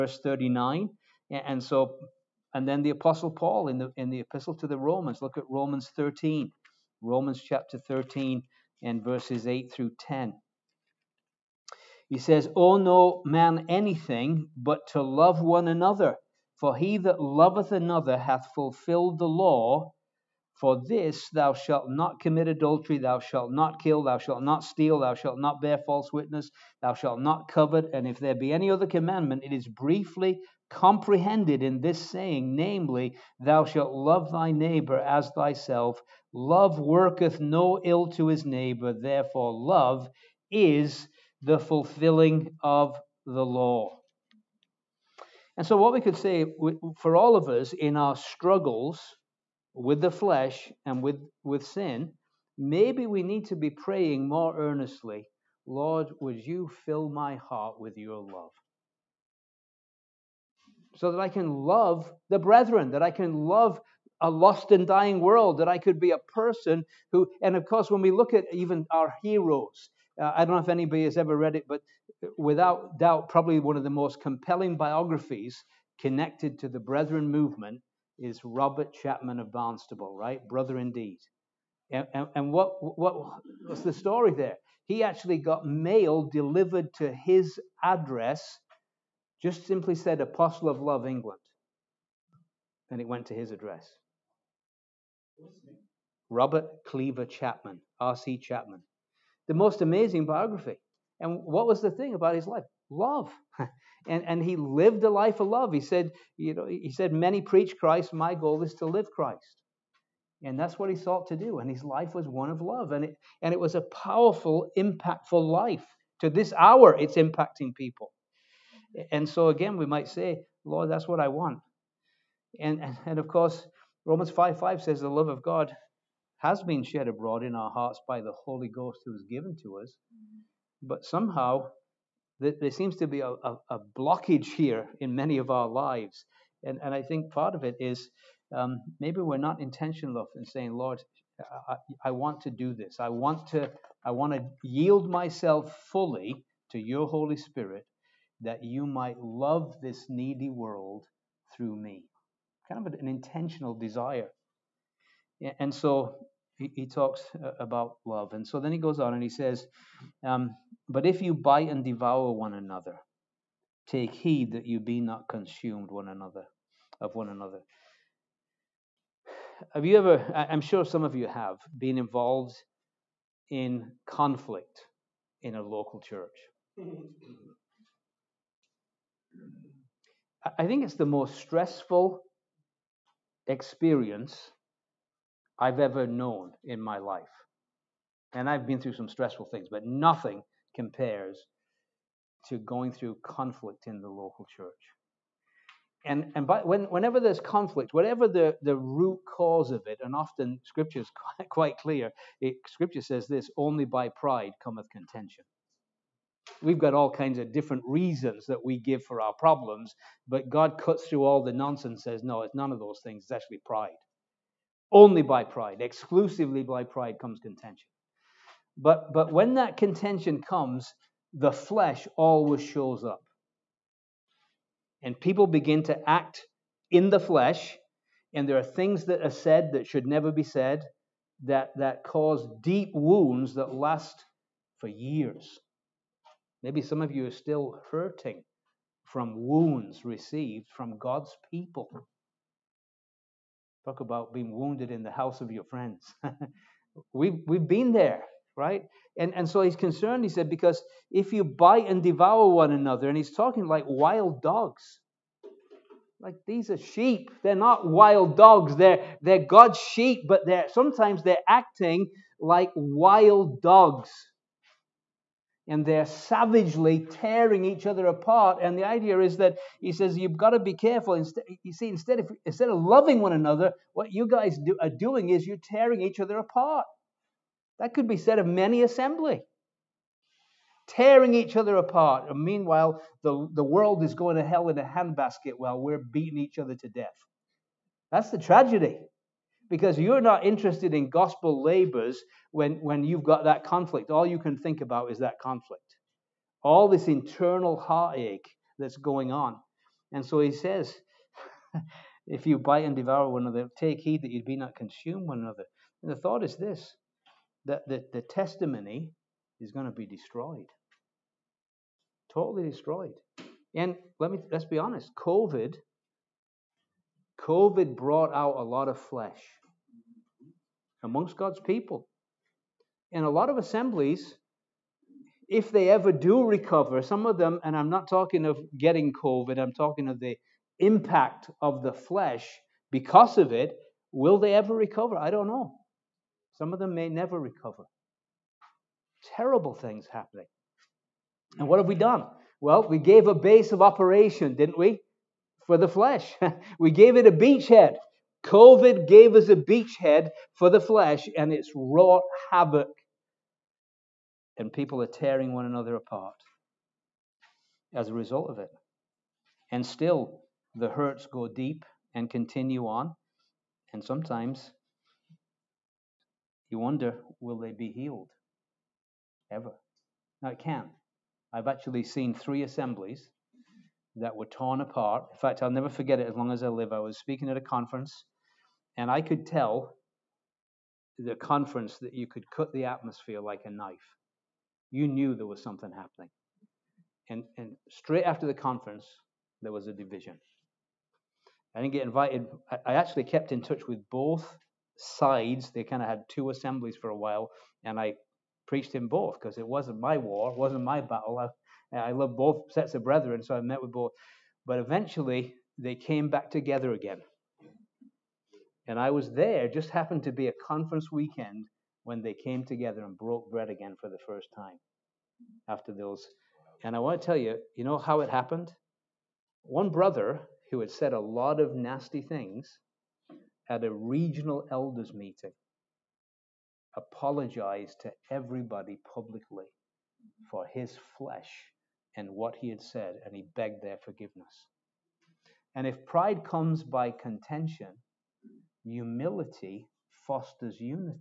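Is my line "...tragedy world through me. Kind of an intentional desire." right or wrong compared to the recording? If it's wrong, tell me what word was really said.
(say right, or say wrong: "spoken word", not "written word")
wrong: "needy", not "tragedy".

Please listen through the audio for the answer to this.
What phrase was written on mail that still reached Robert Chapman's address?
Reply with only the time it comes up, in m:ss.
1:30.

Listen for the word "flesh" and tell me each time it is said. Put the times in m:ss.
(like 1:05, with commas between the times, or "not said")
0:50, 3:41, 3:47, 5:18, 5:31, 5:45, 5:50, 7:11.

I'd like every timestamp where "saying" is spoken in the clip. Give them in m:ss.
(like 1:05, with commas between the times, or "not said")
0:32, 2:20.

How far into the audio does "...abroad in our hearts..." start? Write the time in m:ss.
2:07.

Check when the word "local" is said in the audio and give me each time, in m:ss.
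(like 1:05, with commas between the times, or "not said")
2:55, 3:14.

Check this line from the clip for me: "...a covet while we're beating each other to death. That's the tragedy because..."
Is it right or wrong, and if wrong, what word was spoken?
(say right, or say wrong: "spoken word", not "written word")
wrong: "handbasket", not "covet".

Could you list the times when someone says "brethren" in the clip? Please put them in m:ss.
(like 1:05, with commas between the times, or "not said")
1:02, 1:16, 6:43.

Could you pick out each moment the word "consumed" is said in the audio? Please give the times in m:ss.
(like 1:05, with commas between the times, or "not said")
2:45, 5:04.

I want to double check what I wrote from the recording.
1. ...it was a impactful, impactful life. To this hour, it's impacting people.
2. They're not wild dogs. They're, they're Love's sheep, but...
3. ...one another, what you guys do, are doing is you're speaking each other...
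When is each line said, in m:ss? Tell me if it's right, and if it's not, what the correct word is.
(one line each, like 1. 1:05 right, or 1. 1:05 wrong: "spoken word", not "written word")
1. 1:53 wrong: "powerful", not "impactful"
2. 4:17 wrong: "God", not "Love"
3. 4:33 wrong: "tearing", not "speaking".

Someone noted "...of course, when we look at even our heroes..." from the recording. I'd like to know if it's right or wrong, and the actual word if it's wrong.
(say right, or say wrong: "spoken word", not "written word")
right.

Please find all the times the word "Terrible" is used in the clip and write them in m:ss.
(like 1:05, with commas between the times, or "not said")
5:39.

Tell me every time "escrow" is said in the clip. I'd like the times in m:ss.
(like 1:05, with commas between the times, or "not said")
not said.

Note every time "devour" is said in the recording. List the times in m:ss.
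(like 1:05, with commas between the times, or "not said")
2:41, 4:12, 5:02.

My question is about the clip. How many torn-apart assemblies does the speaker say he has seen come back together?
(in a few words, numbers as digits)
3.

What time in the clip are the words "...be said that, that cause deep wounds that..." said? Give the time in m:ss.
3:50.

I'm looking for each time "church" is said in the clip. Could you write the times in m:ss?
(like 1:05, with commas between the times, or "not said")
2:56, 3:14.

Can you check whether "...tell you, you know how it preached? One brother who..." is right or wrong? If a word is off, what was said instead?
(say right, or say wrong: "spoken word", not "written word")
wrong: "happened", not "preached".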